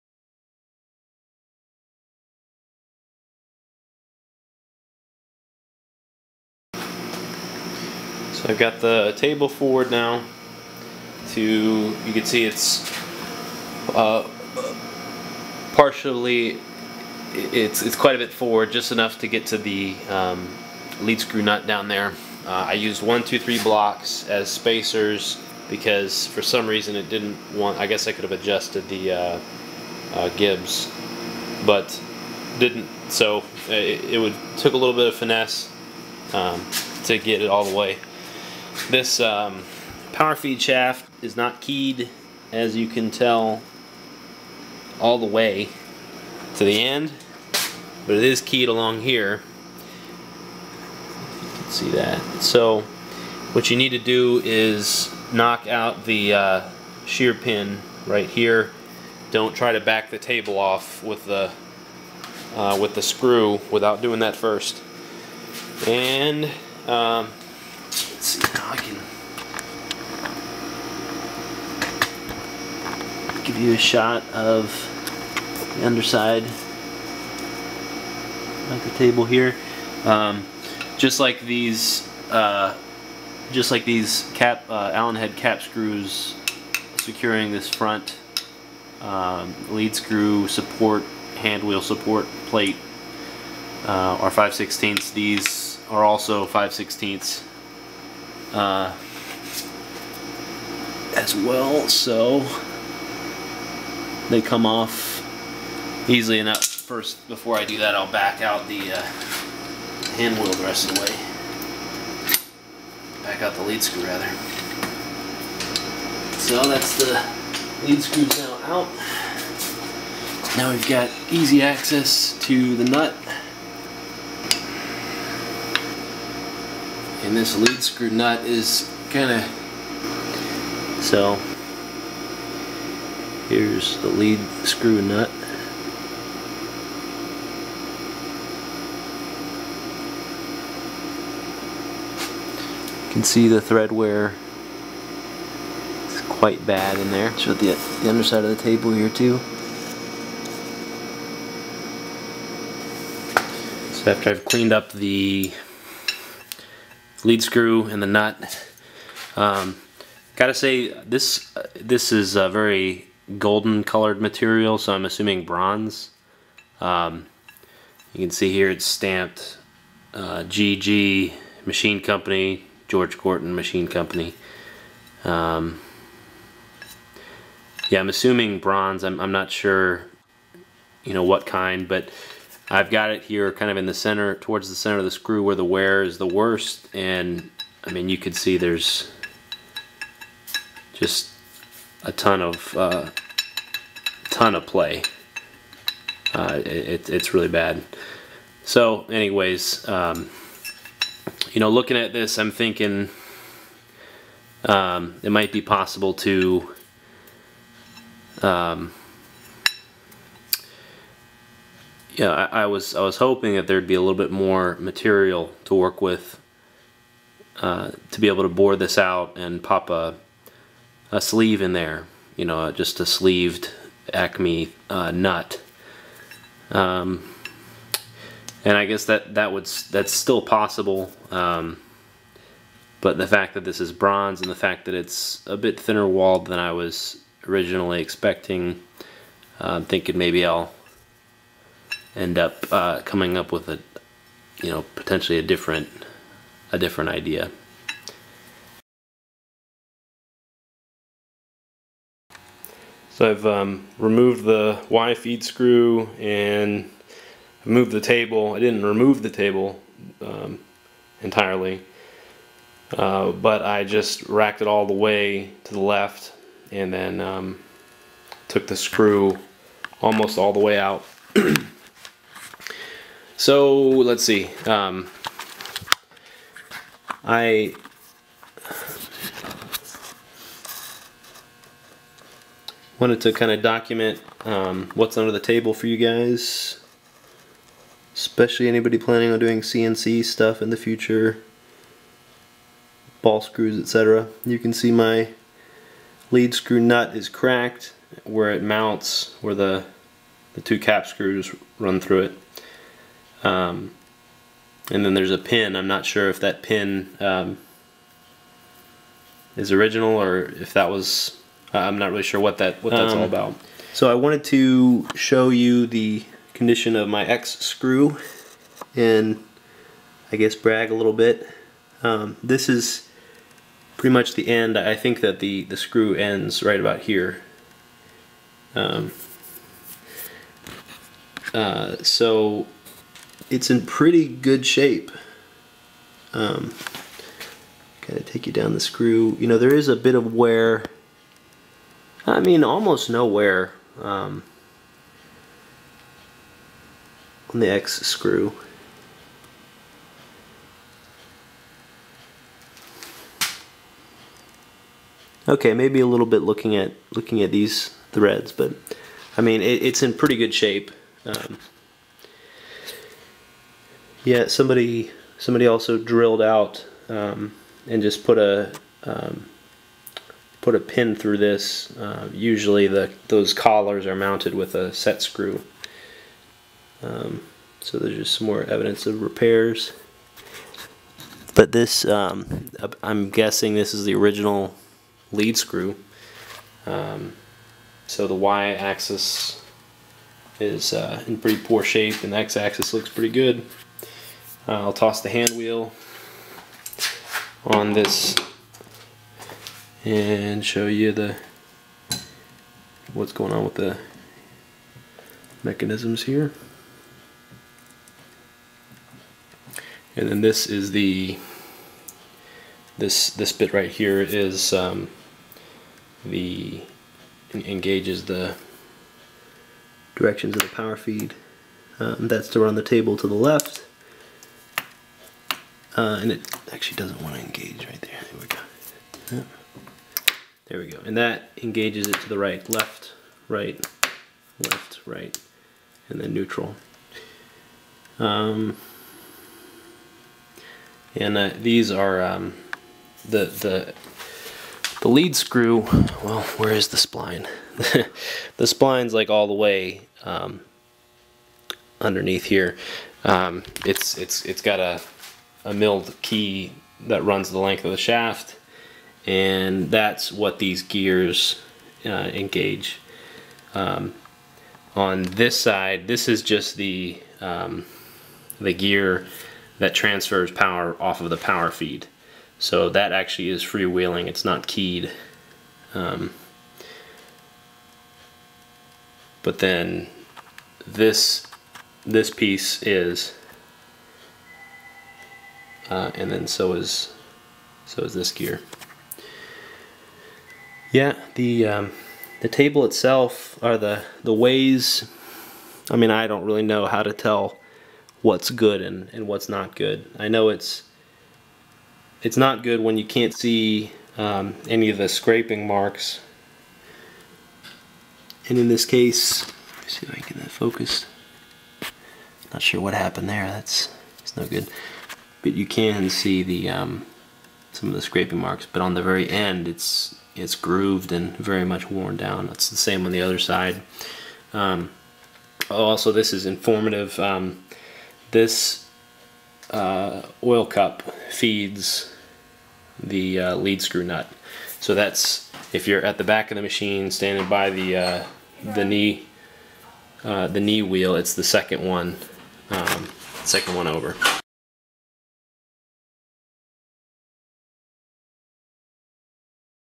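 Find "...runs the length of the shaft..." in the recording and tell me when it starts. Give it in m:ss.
7:37.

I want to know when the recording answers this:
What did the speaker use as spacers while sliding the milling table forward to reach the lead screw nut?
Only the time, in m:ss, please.
0:23.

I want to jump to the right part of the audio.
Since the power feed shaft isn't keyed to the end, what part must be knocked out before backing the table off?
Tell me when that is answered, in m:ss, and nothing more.
0:57.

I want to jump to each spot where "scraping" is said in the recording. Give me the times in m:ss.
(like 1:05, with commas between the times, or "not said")
8:25, 8:38.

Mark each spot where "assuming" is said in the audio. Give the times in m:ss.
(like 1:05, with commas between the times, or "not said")
2:45, 2:58.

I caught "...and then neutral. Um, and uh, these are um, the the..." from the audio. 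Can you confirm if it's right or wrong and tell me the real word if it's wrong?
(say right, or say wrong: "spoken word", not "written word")
right.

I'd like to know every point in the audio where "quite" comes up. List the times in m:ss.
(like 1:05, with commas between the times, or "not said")
0:17, 2:26.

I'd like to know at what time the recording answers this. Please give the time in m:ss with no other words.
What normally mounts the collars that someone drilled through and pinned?
6:14.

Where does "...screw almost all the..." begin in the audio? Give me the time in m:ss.
4:28.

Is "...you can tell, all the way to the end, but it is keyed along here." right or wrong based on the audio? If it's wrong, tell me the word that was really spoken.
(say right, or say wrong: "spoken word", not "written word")
right.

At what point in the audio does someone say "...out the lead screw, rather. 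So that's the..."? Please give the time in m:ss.
1:53.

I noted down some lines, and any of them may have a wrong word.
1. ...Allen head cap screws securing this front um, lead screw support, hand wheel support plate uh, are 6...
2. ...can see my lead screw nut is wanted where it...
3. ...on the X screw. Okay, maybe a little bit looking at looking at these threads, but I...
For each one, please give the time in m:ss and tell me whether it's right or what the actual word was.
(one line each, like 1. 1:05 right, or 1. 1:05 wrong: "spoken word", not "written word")
1. 1:24 wrong: "5", not "6"
2. 4:54 wrong: "cracked", not "wanted"
3. 5:47 right.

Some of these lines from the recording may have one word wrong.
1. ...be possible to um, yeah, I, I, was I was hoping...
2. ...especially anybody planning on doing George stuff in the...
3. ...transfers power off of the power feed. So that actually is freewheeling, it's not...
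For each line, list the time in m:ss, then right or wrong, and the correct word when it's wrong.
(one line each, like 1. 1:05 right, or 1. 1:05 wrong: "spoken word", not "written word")
1. 3:25 right
2. 4:48 wrong: "CNC", not "George"
3. 7:49 right.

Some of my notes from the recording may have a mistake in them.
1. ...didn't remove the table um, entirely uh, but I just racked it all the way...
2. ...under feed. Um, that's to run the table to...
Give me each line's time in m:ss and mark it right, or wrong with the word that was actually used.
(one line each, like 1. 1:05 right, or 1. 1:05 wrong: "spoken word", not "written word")
1. 4:18 right
2. 7:00 wrong: "power", not "under".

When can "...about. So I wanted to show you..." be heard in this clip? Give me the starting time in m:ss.
5:13.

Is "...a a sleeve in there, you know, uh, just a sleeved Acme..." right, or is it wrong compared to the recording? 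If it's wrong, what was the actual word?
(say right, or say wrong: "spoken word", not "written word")
right.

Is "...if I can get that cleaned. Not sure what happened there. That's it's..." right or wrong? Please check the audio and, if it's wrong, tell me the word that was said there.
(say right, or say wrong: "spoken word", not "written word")
wrong: "focused", not "cleaned".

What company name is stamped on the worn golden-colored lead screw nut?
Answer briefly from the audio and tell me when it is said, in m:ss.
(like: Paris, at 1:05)
George Gorton Machine Company, at 2:52.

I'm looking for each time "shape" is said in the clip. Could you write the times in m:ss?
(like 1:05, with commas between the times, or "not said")
5:34, 6:00, 6:31.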